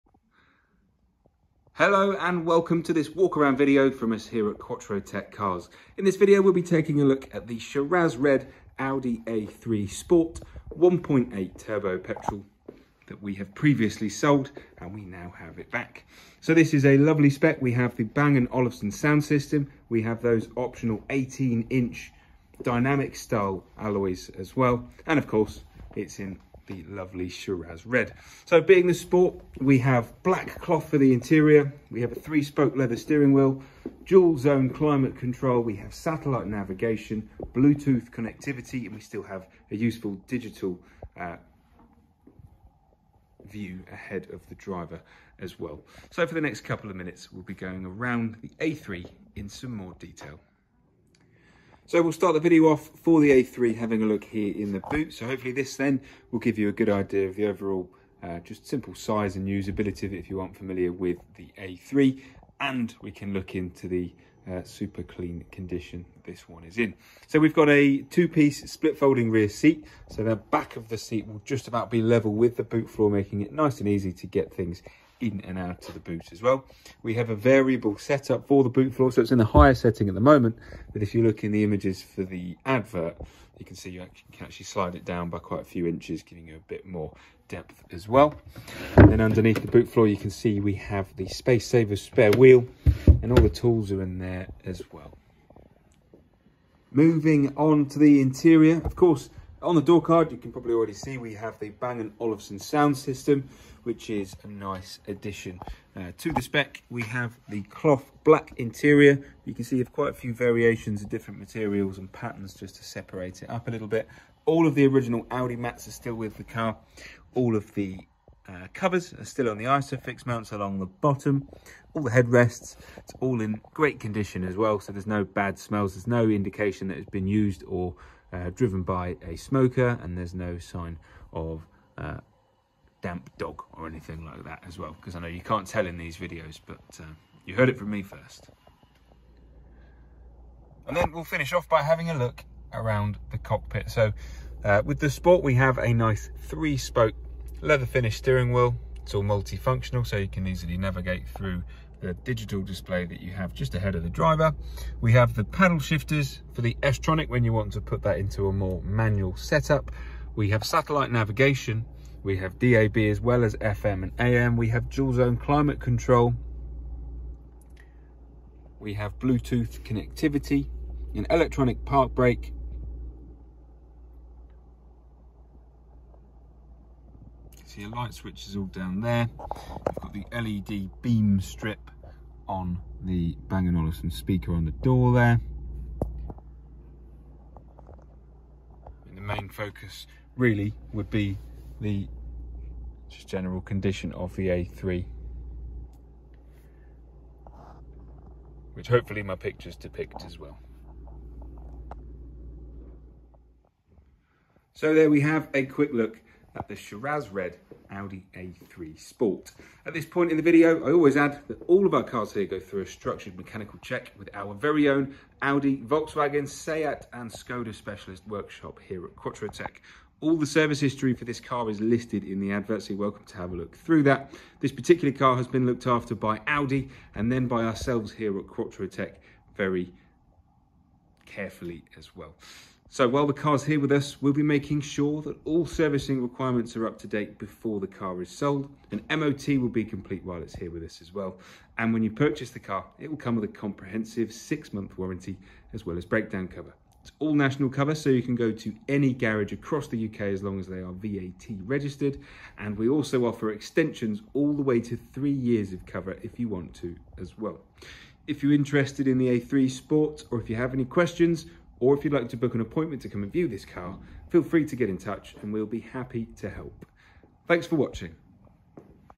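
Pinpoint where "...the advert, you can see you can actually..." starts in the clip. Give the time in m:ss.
1:22.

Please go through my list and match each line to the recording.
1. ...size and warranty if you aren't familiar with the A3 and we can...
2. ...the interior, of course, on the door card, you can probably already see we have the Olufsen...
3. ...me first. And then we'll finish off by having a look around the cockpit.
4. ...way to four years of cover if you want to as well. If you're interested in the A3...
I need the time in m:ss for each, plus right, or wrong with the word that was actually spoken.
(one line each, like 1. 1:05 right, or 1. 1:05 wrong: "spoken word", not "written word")
1. 0:58 wrong: "usability", not "warranty"
2. 1:37 wrong: "Bang", not "Olufsen"
3. 2:17 right
4. 4:14 wrong: "three", not "four".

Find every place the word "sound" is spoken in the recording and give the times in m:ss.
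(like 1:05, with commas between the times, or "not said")
0:18, 1:42.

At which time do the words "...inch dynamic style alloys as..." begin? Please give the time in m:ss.
0:21.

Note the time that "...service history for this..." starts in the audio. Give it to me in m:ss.
3:40.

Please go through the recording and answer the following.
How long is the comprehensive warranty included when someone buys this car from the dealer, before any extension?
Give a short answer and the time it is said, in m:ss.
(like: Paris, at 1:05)
6 months, at 4:04.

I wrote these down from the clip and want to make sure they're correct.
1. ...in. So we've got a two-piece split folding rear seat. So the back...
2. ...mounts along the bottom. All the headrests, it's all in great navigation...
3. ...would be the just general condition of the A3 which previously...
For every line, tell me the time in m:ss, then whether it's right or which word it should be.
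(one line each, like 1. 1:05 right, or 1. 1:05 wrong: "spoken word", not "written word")
1. 1:06 right
2. 2:00 wrong: "condition", not "navigation"
3. 3:10 wrong: "hopefully", not "previously".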